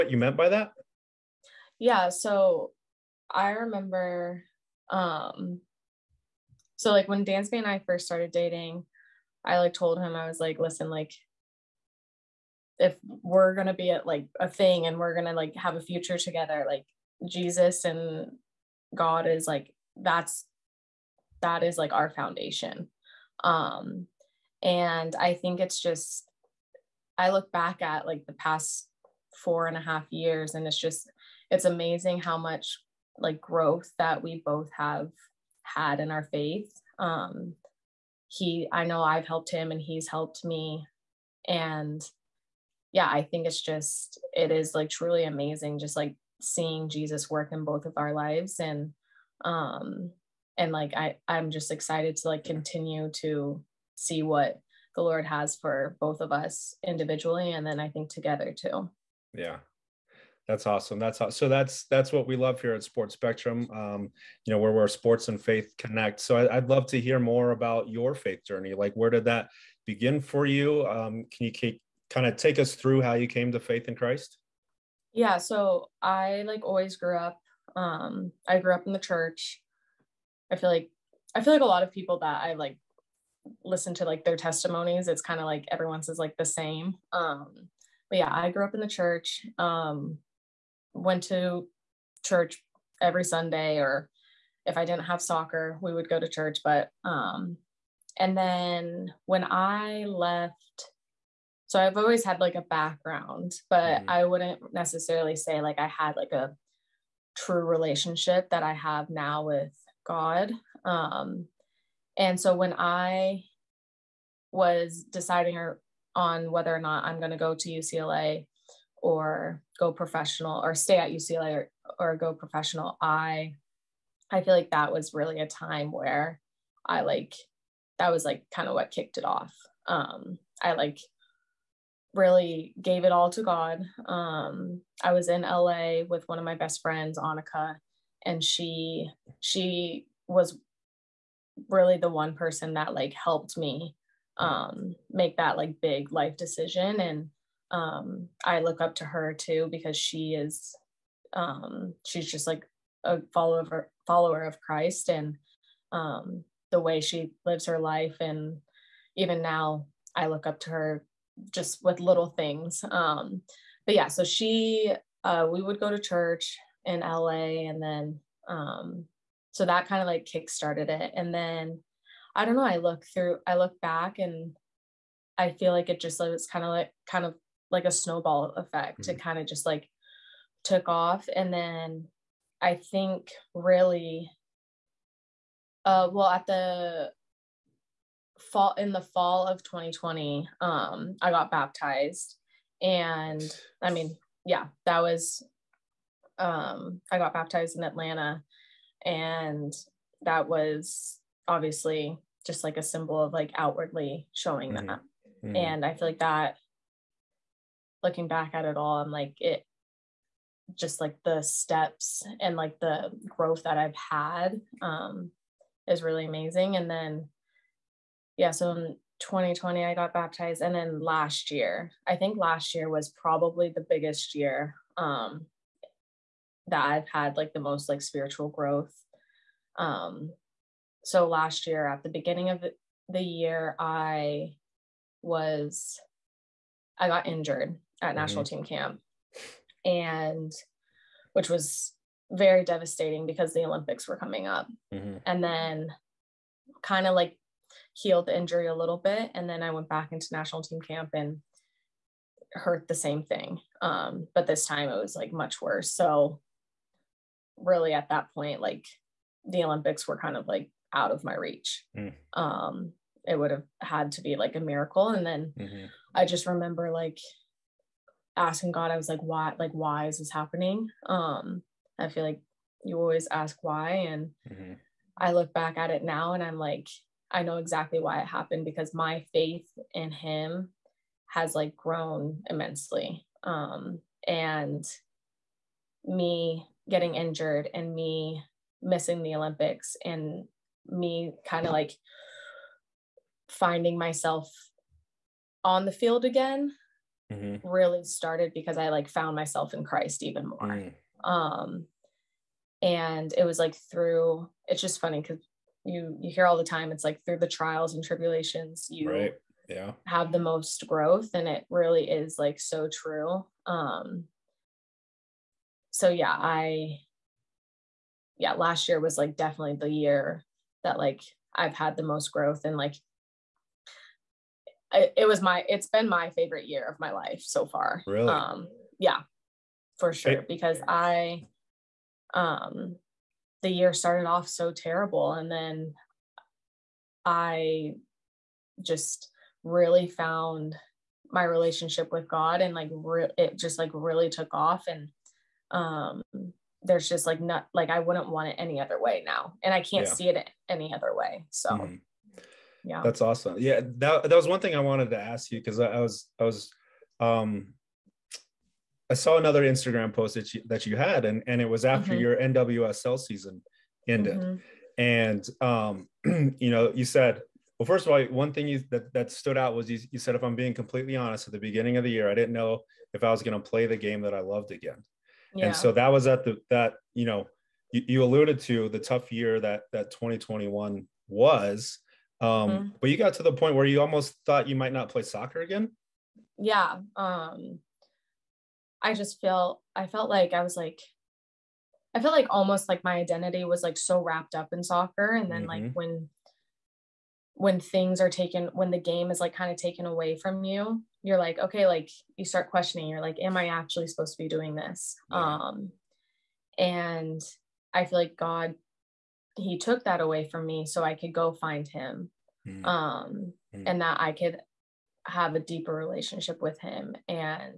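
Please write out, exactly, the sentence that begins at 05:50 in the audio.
see it any other way so mm-hmm.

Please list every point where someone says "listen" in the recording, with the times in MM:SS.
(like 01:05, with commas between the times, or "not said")
00:10, 01:23.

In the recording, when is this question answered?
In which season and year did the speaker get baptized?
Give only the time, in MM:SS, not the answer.
03:08.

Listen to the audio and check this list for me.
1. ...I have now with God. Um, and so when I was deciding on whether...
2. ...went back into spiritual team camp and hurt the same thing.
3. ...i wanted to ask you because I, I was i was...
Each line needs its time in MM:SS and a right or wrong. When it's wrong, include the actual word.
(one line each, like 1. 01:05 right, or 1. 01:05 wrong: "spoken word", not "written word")
1. 01:48 right
2. 04:09 wrong: "national", not "spiritual"
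3. 05:54 right.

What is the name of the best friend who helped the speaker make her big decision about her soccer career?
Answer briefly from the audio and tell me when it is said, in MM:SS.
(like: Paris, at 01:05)
Annika, at 02:17.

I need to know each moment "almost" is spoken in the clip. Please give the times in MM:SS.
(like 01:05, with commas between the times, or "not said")
06:24, 06:32.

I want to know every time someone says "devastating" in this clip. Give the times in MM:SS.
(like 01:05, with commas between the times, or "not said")
04:02.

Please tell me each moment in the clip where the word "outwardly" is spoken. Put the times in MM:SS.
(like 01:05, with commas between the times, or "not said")
03:23.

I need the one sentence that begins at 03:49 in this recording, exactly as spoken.
Um, so last year at the beginning of the year, I was I got injured at mm-hmm.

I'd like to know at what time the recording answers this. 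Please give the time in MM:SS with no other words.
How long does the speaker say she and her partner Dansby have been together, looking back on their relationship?
00:29.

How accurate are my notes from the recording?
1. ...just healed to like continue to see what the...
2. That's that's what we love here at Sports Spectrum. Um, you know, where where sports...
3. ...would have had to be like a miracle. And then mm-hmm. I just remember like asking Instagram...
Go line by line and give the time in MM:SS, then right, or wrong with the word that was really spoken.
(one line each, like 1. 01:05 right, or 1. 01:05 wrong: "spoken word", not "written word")
1. 00:51 wrong: "excited", not "healed"
2. 01:01 right
3. 04:23 wrong: "God", not "Instagram".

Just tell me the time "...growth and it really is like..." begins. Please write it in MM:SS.
05:10.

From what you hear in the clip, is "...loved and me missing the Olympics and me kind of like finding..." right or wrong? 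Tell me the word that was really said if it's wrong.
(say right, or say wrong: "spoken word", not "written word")
wrong: "injured", not "loved".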